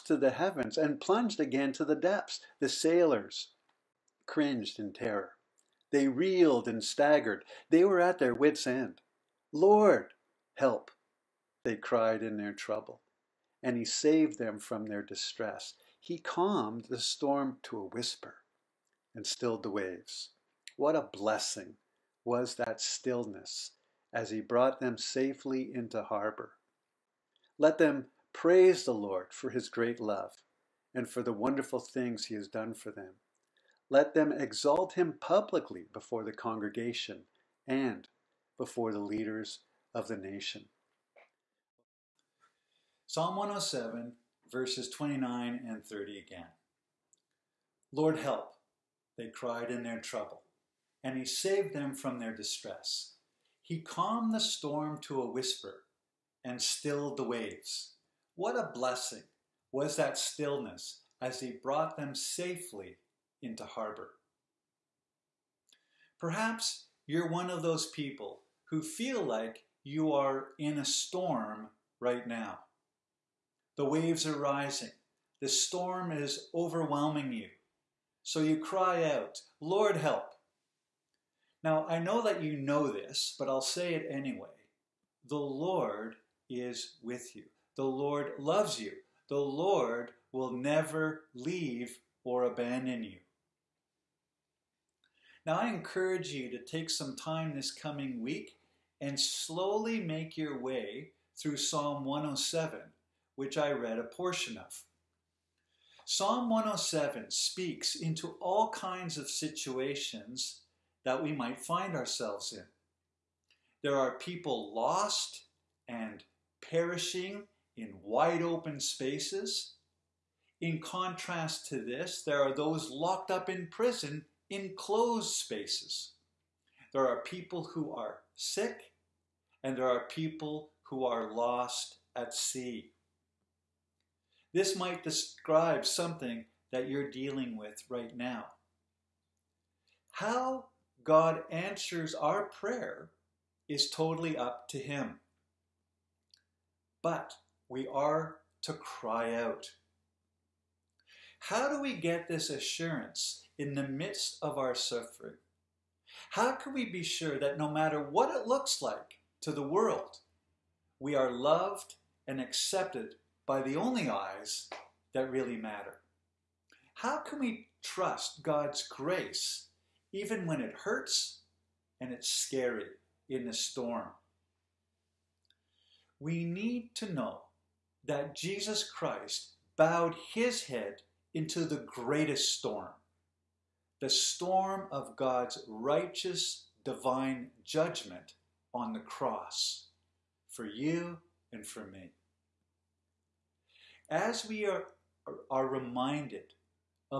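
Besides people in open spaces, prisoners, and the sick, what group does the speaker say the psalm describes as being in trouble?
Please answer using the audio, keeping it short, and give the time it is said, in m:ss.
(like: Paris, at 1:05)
lost at sea, at 2:11.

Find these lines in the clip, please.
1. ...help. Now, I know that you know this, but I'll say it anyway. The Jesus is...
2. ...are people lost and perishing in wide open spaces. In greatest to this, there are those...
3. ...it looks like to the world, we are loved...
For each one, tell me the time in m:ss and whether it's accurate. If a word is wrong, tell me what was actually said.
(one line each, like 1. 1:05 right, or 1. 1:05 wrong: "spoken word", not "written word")
1. 1:19 wrong: "Lord", not "Jesus"
2. 1:53 wrong: "contrast", not "greatest"
3. 2:38 right.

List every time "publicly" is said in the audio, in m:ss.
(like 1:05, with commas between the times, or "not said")
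0:35.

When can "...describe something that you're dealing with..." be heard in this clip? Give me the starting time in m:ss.
2:15.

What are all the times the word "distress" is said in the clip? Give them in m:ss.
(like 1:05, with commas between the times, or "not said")
0:15, 0:52.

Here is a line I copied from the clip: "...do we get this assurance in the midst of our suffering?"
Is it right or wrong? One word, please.
right.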